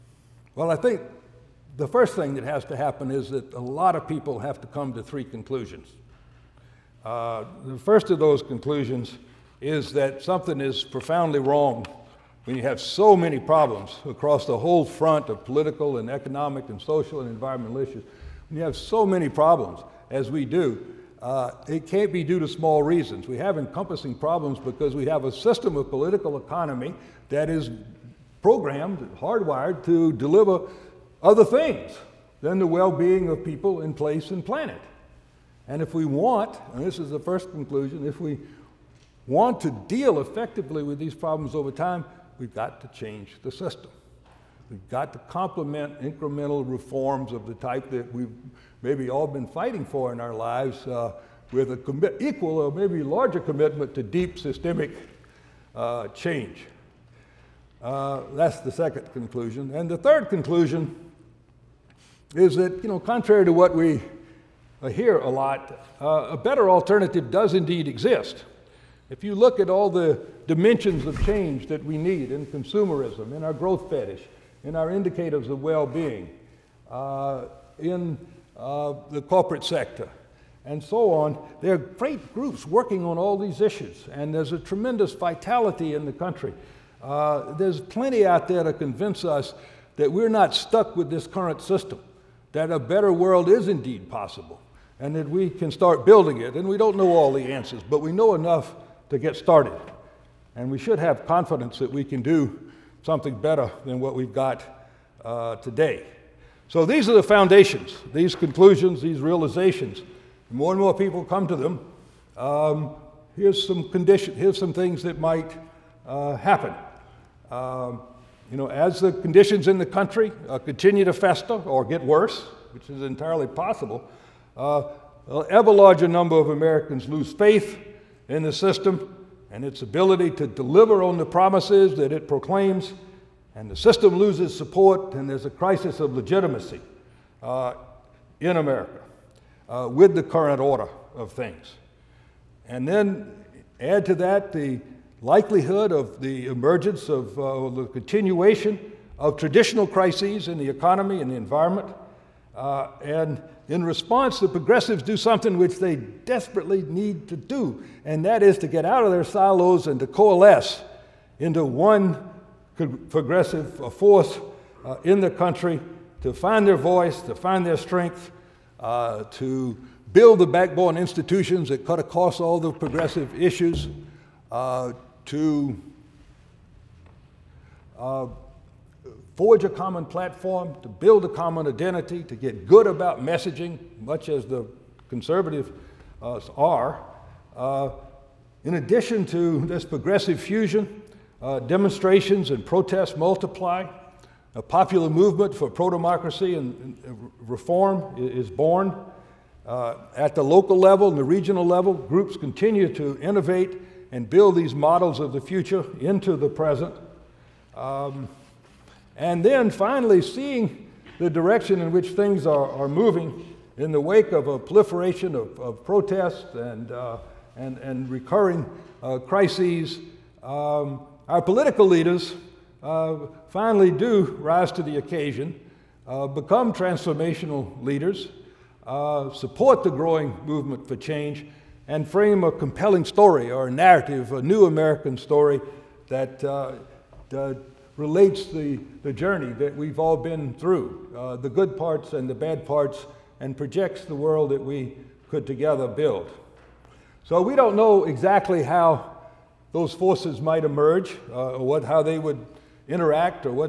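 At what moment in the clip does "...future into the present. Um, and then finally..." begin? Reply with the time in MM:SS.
03:25.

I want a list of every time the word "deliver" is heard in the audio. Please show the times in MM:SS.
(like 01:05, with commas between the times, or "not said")
00:30, 02:10.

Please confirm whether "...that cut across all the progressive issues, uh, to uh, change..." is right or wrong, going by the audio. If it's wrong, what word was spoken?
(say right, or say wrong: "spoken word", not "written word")
wrong: "forge", not "change".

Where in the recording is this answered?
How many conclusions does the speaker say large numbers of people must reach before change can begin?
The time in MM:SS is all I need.
00:05.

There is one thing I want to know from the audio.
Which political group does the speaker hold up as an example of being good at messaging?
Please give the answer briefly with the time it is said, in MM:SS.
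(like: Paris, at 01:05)
The conservatives, at 03:05.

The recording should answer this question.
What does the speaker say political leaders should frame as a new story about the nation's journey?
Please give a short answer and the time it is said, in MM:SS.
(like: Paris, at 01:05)
A new American story, at 03:54.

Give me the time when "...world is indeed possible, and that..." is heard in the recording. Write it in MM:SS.
01:33.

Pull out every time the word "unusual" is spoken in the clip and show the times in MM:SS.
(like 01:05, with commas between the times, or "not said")
not said.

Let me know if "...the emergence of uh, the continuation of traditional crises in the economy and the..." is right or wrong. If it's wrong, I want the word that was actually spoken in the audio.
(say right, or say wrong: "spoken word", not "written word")
right.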